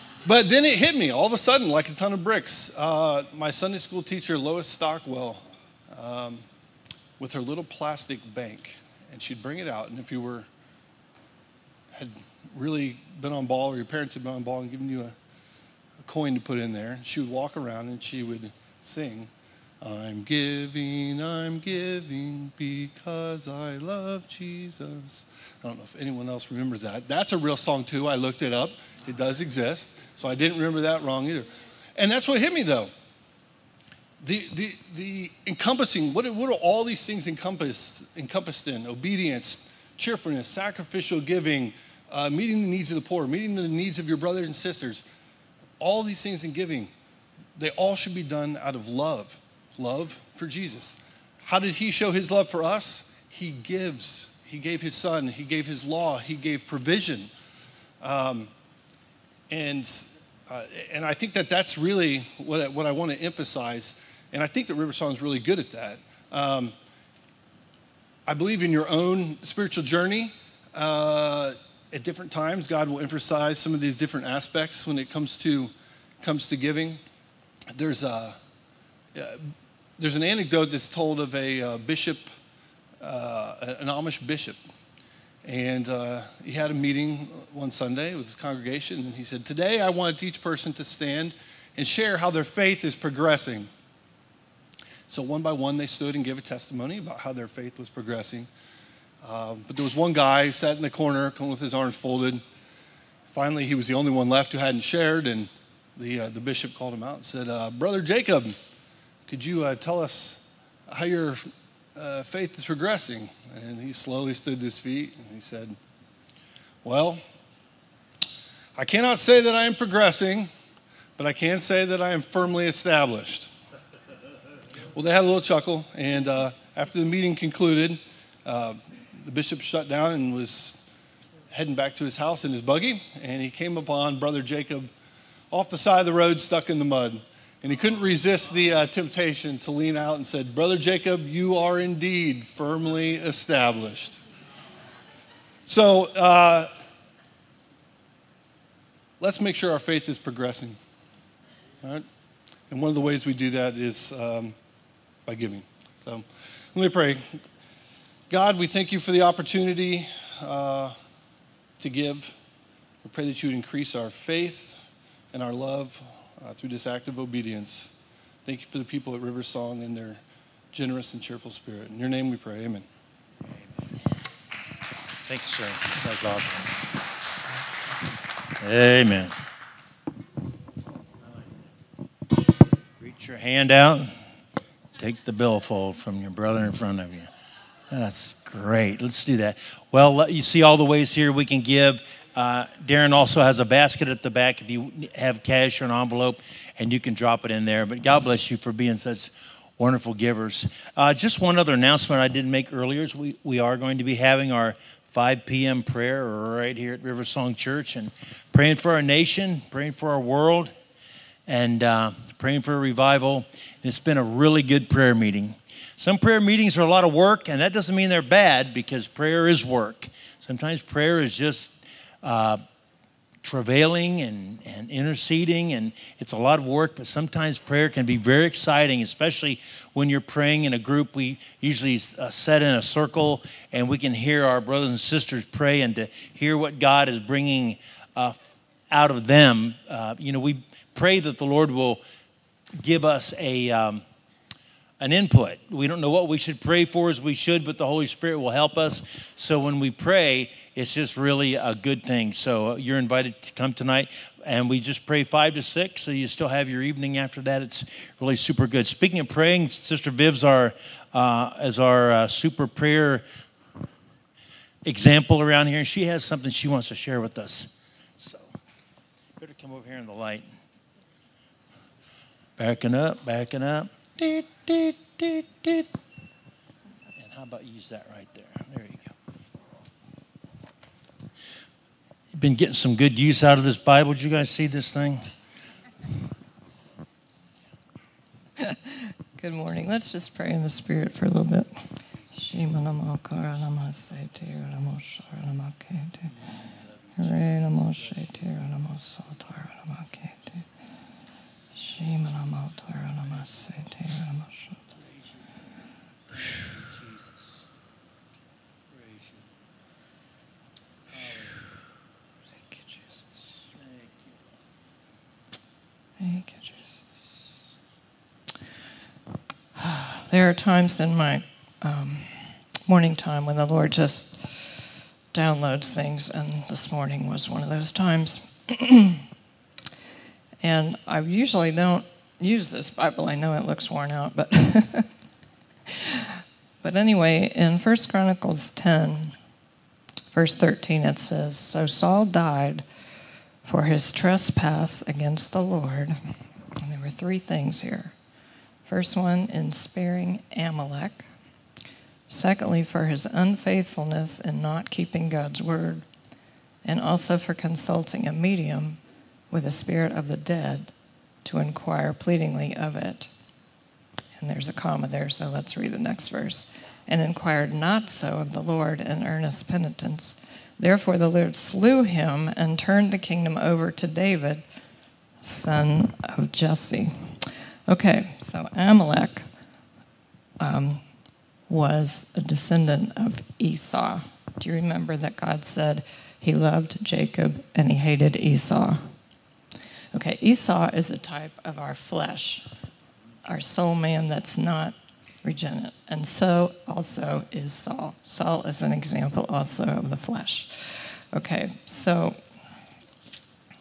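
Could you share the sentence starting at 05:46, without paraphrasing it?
And there were three things here.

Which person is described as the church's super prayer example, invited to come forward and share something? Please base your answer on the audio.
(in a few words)
Sister Viv.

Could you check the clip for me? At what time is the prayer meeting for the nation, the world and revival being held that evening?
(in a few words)
5 p.m.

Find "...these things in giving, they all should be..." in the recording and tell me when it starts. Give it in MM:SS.
00:46.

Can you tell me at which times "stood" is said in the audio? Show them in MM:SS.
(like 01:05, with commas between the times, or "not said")
01:35, 01:54.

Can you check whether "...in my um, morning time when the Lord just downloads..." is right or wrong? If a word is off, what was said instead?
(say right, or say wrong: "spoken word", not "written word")
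right.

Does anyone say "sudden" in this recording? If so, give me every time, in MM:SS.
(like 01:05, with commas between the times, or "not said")
00:01.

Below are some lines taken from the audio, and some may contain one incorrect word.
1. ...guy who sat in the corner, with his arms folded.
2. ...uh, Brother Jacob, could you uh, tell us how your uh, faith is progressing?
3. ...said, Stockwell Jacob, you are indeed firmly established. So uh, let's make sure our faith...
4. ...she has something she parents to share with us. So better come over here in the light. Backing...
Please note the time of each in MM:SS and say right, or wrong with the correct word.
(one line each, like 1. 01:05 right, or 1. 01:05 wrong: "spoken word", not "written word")
1. 01:40 right
2. 01:47 right
3. 02:20 wrong: "Brother", not "Stockwell"
4. 04:25 wrong: "wants", not "parents".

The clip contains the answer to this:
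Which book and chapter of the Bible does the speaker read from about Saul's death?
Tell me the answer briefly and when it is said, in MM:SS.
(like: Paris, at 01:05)
First Chronicles 10, at 05:37.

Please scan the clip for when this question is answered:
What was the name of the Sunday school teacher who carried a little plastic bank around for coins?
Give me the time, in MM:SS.
00:04.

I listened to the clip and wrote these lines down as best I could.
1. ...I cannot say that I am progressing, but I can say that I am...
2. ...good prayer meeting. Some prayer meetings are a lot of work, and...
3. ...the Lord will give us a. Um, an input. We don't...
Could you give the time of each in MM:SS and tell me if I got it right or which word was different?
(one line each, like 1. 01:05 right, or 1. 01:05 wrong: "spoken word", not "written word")
1. 01:58 right
2. 03:34 right
3. 04:01 right.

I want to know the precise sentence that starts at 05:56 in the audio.
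And also for consulting a medium with a spirit of the dead to inquire pleadingly of it.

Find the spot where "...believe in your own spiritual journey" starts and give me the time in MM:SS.
01:08.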